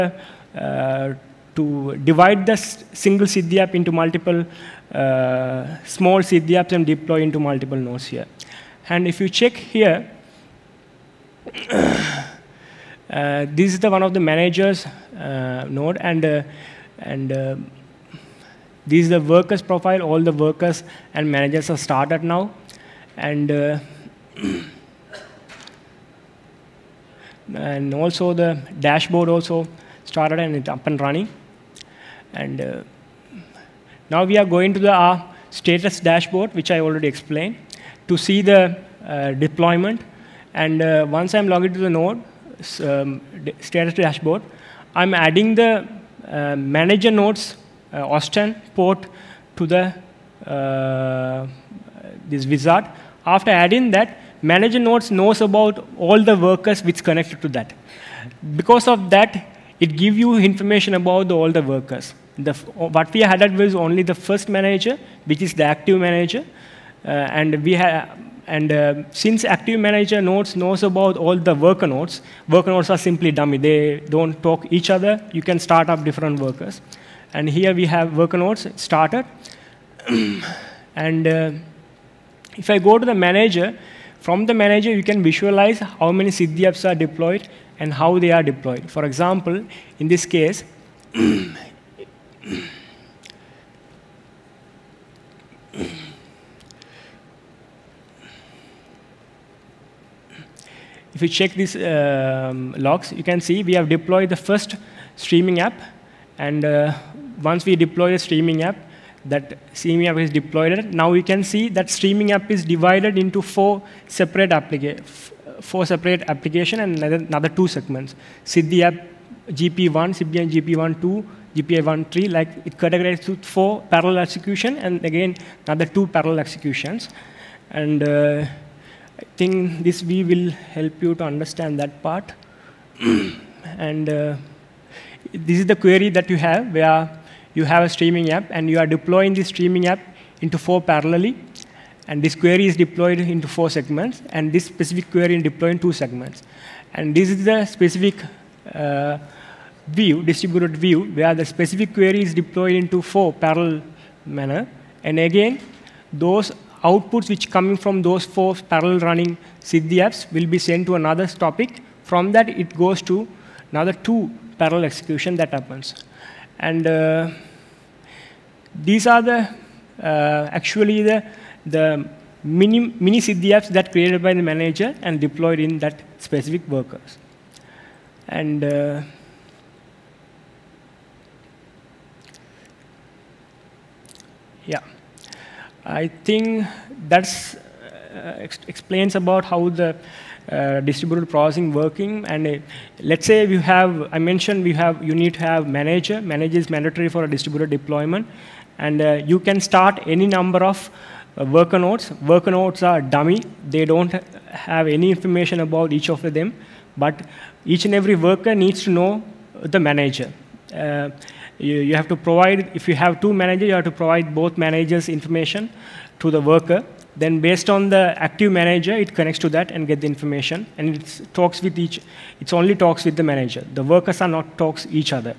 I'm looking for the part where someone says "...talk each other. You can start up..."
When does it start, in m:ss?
1:14.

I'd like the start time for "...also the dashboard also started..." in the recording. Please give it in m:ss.
0:27.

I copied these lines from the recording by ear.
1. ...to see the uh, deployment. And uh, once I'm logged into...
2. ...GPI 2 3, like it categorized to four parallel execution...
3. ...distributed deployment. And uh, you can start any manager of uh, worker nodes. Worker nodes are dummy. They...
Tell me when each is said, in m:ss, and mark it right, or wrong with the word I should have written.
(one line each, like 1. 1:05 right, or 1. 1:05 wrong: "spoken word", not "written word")
1. 0:38 right
2. 2:01 wrong: "1", not "2"
3. 3:17 wrong: "number", not "manager".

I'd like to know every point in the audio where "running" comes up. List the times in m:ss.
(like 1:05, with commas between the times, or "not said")
0:30, 2:39.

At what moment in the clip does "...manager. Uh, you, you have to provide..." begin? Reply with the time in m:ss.
3:29.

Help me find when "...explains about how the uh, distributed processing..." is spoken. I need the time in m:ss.
3:08.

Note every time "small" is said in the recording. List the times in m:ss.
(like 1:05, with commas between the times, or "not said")
0:05.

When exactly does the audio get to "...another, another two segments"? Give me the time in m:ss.
1:57.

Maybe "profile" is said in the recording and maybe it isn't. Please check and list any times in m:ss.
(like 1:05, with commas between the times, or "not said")
0:19.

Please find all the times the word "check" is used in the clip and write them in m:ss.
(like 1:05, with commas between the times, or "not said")
0:09, 1:41.